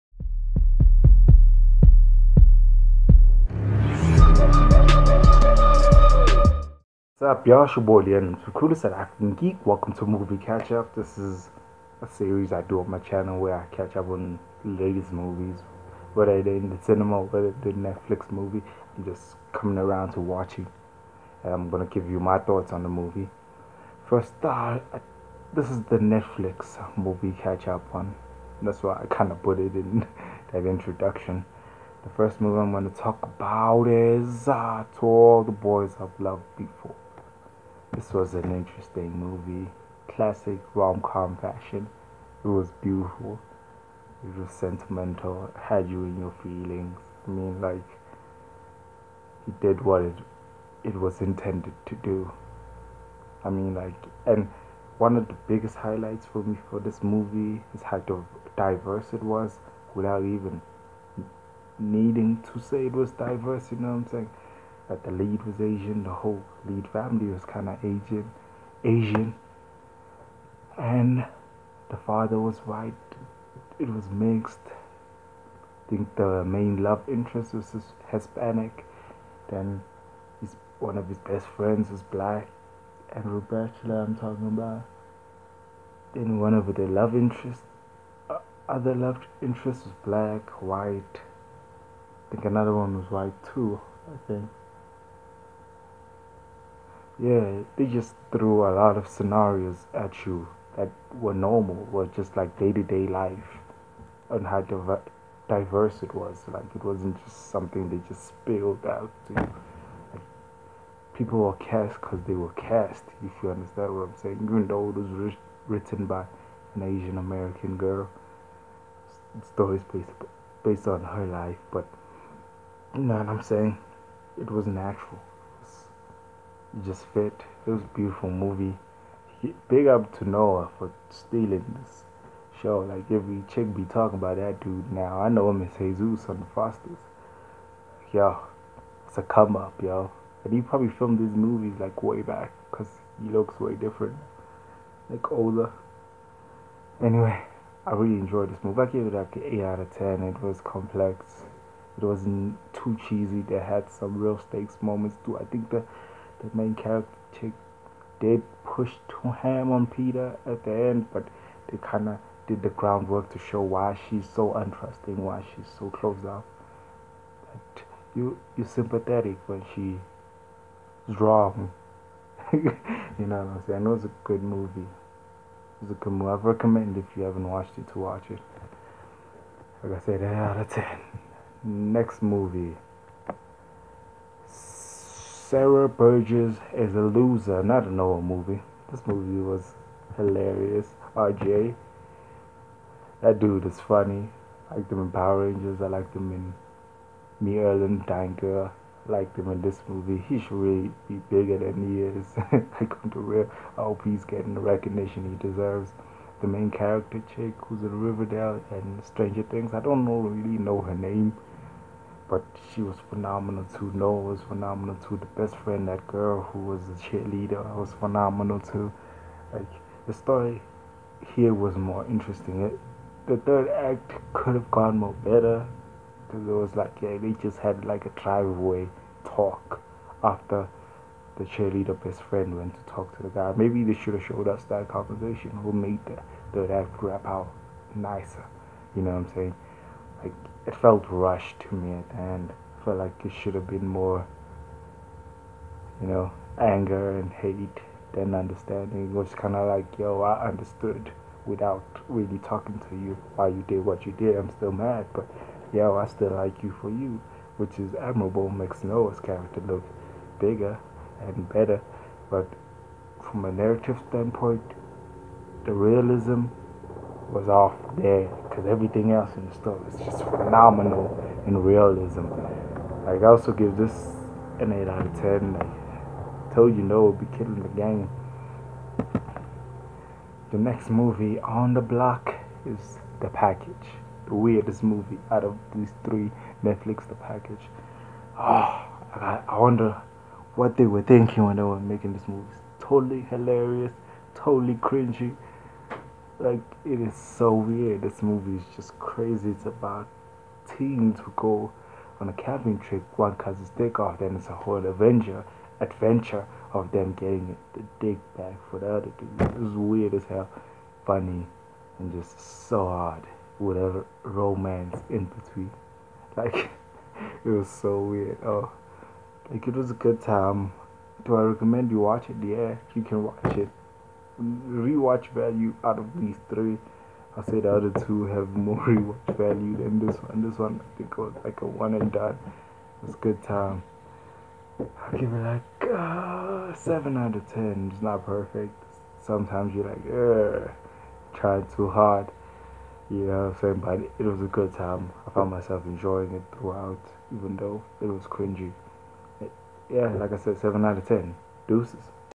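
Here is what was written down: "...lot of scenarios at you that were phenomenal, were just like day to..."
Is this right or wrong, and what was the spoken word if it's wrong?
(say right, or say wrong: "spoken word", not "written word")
wrong: "normal", not "phenomenal".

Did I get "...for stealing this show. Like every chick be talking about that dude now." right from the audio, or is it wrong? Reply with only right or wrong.
right.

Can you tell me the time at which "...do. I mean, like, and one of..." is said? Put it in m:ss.
0:51.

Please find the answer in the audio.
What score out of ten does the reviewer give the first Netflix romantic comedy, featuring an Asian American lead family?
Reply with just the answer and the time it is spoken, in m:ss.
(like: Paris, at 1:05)
8, at 2:29.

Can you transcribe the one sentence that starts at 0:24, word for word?
First, uh, this is the Netflix movie catch up one.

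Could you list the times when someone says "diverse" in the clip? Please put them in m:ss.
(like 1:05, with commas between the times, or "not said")
0:58, 1:03, 1:45.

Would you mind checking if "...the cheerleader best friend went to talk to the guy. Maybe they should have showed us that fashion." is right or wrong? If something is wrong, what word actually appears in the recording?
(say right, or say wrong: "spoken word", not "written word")
wrong: "conversation", not "fashion".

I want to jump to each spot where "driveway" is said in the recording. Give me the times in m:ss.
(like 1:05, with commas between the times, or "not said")
3:48.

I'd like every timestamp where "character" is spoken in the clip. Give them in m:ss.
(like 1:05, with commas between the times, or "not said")
2:36, 3:26, 4:19.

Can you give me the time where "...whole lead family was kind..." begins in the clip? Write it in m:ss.
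1:06.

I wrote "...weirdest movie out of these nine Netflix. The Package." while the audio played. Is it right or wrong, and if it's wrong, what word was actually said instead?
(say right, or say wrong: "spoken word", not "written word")
wrong: "three", not "nine".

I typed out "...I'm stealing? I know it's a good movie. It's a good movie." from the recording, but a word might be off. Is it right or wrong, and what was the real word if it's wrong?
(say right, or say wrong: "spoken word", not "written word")
wrong: "saying", not "stealing".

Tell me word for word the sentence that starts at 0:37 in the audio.
This was an interesting movie, classic rom com fashion.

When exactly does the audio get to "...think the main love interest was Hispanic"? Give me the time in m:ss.
1:15.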